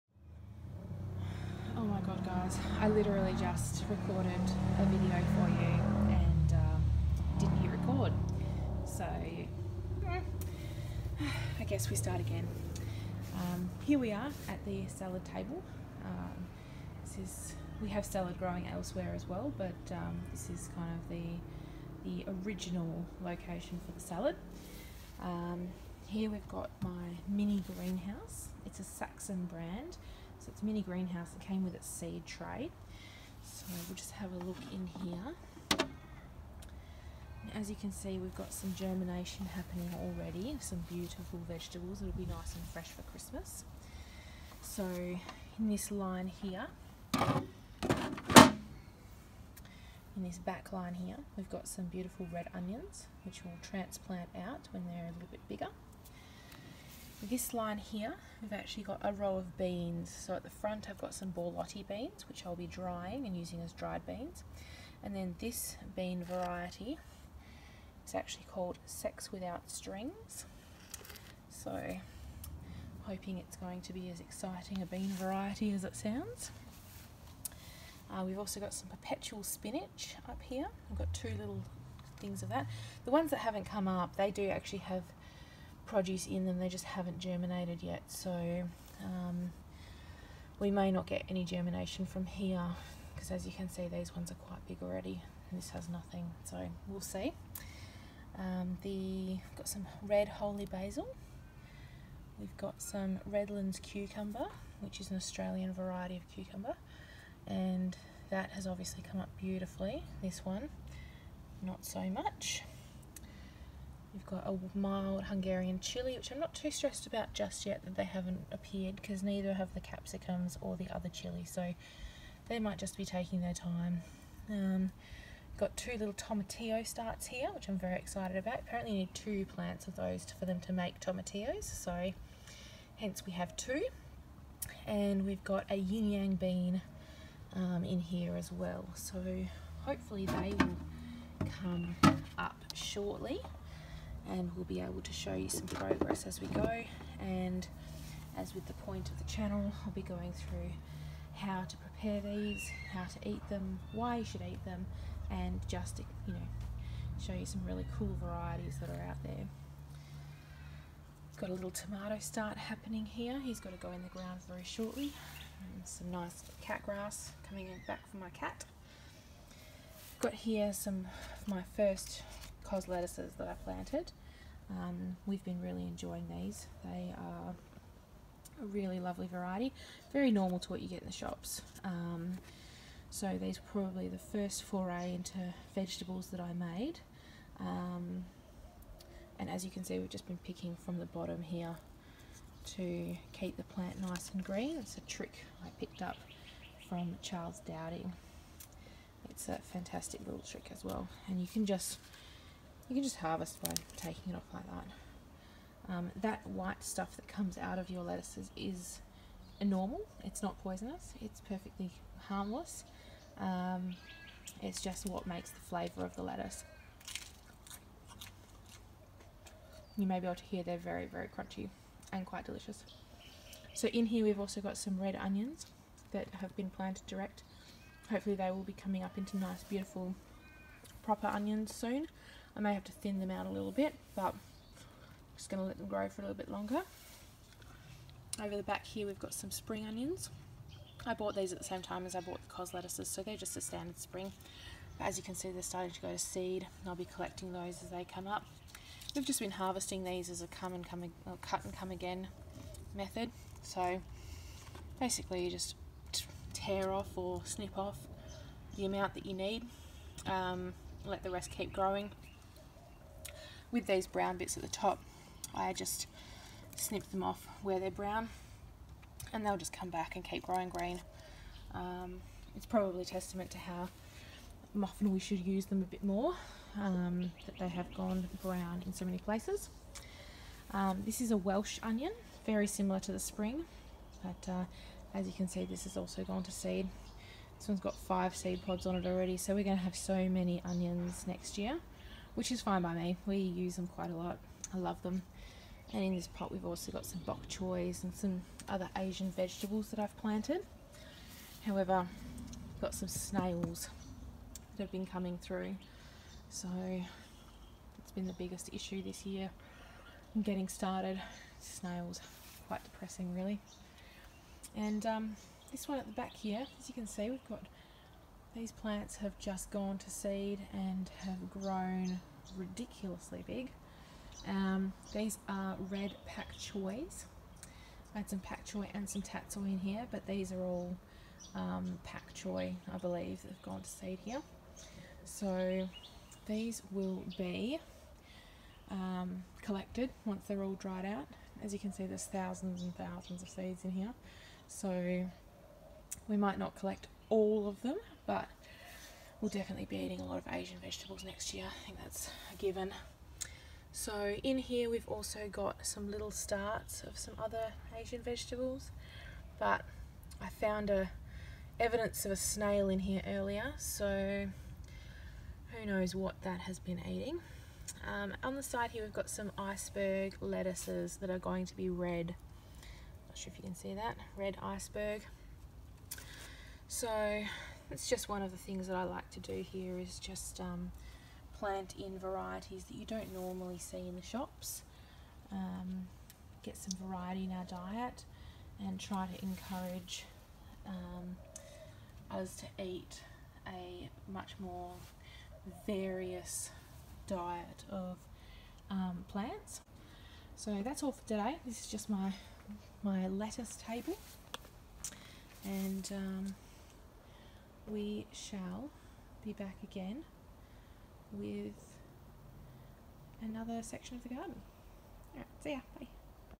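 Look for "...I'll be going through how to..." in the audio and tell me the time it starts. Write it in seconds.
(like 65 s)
149 s.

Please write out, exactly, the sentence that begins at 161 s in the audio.
Got a little tomato start happening here.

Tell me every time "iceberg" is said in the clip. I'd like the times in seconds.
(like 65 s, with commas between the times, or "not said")
369 s, 374 s.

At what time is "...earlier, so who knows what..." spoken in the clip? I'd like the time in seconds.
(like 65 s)
363 s.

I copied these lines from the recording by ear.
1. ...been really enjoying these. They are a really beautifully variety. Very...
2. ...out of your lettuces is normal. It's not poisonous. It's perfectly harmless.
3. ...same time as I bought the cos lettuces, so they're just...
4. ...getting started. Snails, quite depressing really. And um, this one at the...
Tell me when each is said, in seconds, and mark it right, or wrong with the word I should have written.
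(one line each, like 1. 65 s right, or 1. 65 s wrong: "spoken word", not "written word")
1. 175 s wrong: "lovely", not "beautifully"
2. 207 s right
3. 241 s right
4. 310 s right.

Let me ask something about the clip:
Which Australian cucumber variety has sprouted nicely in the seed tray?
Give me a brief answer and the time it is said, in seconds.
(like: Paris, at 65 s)
Redlands, at 103 s.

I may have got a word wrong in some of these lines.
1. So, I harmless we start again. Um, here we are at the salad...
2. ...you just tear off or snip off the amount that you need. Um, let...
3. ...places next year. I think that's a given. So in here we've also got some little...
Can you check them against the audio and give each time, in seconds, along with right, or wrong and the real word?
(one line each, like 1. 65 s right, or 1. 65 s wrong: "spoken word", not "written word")
1. 8 s wrong: "guess", not "harmless"
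2. 255 s right
3. 350 s wrong: "vegetables", not "places".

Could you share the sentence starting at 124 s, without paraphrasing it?
Um, got two little tomatillo starts here, which I'm very excited about.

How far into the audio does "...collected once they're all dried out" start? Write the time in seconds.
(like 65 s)
339 s.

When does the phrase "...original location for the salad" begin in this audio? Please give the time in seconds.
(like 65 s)
22 s.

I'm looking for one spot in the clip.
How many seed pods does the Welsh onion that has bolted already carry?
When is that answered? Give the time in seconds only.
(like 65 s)
287 s.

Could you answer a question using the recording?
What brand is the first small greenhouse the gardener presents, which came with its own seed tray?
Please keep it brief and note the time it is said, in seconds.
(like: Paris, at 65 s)
Saxon, at 28 s.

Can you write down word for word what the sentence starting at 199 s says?
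It's a fantastic little trick as well.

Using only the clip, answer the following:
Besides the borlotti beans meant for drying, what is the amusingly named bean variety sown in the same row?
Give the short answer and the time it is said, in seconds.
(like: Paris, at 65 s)
Sex Without Strings, at 68 s.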